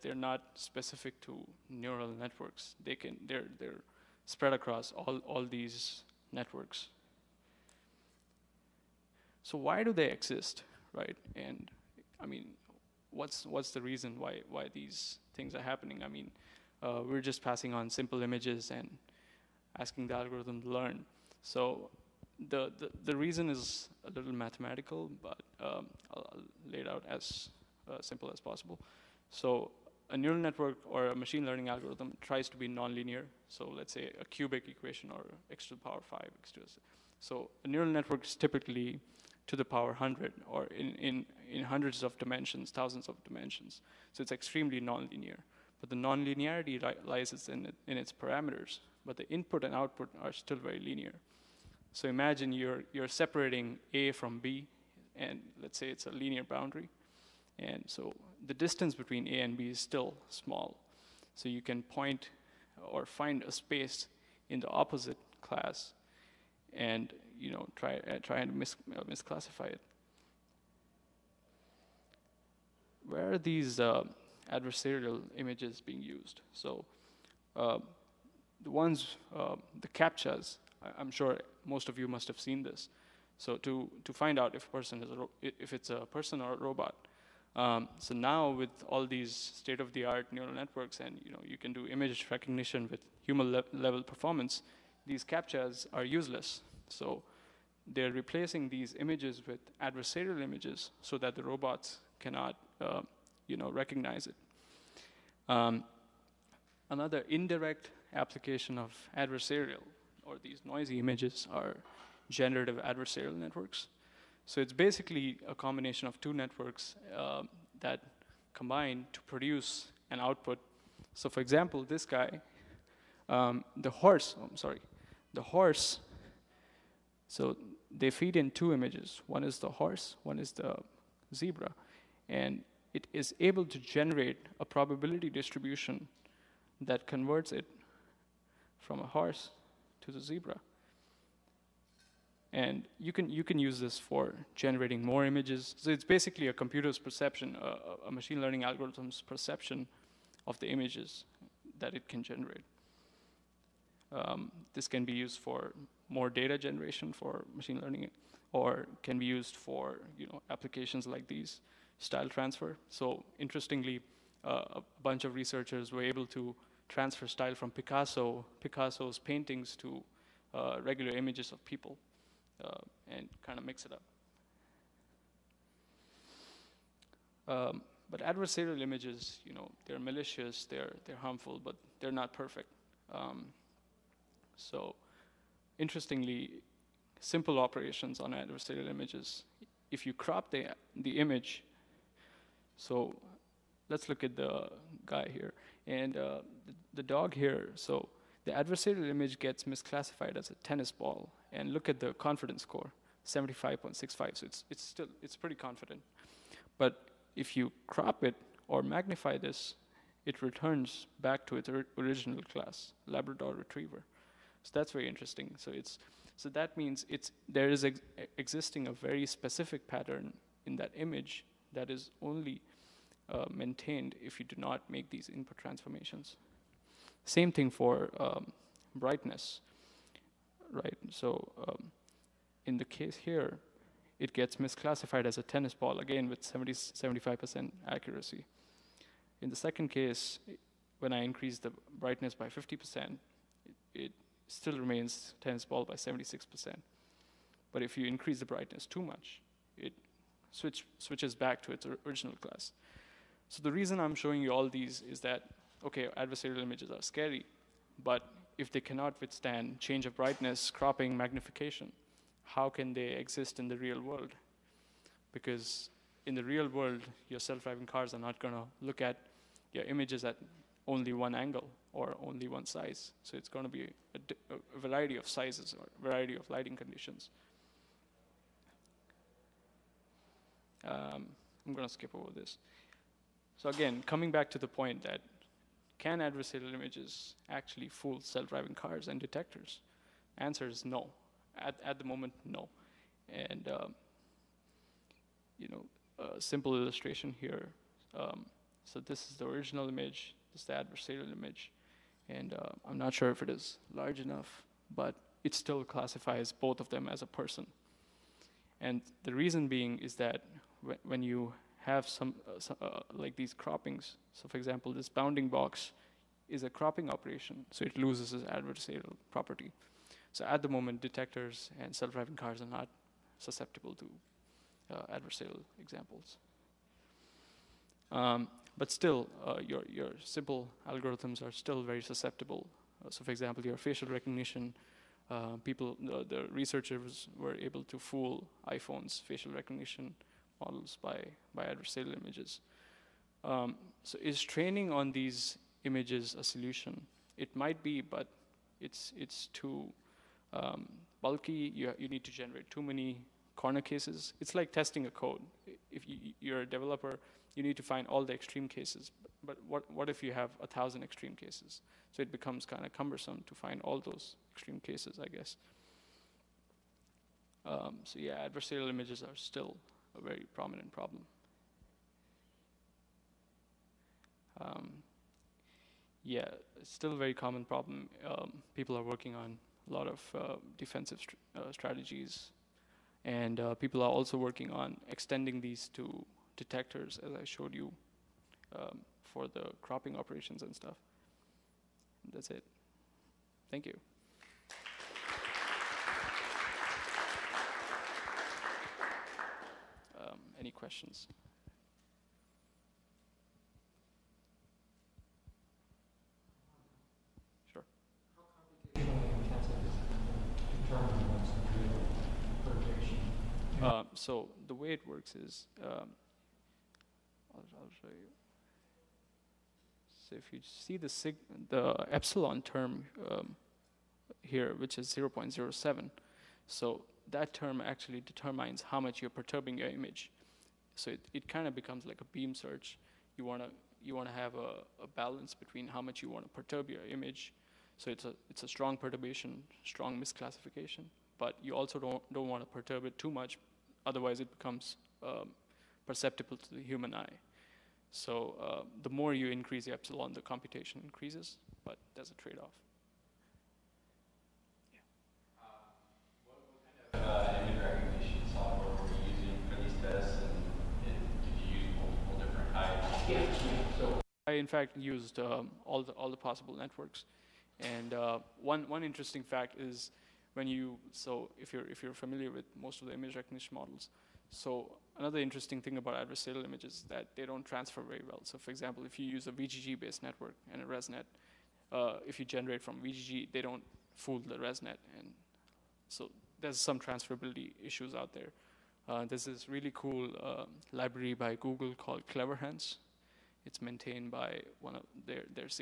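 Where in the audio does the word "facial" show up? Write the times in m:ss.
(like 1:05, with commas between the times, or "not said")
5:33, 5:39.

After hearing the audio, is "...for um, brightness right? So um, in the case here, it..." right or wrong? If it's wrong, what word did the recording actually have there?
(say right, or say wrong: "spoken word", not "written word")
right.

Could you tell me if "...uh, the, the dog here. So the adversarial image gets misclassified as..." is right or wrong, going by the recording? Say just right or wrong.
right.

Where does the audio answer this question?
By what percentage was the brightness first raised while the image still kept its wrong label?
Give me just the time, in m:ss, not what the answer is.
4:02.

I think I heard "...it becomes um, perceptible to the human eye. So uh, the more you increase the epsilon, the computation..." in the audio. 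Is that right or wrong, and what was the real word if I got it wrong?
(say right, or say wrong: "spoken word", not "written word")
right.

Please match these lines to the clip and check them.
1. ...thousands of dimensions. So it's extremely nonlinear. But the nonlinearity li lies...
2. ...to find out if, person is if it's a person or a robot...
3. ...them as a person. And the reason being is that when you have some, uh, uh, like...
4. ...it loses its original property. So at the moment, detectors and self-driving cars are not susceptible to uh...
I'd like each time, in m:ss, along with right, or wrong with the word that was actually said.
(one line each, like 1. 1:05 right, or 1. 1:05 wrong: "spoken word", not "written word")
1. 0:42 right
2. 1:24 right
3. 5:06 right
4. 5:17 wrong: "adversarial", not "original".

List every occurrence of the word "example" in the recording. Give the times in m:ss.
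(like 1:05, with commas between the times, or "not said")
2:01, 5:14, 5:25, 5:33, 7:58.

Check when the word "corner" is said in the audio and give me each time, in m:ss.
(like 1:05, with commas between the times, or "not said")
5:53.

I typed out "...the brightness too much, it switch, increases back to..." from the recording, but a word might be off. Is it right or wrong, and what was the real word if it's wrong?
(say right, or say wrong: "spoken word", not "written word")
wrong: "switches", not "increases".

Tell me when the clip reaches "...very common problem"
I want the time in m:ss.
6:17.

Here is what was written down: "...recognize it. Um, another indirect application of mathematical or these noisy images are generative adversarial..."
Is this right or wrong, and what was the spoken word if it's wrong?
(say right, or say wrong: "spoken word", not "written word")
wrong: "adversarial", not "mathematical".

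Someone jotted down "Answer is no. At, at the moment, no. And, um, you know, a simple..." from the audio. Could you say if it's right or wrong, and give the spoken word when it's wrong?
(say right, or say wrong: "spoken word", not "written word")
right.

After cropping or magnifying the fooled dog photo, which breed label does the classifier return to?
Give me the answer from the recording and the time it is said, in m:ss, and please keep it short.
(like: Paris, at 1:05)
Labrador Retriever, at 3:33.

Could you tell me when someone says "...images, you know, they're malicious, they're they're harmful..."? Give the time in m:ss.
2:58.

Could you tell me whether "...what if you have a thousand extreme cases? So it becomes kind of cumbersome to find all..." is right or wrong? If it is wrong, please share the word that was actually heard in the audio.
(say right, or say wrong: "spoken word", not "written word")
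right.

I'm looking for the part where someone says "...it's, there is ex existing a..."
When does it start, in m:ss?
3:37.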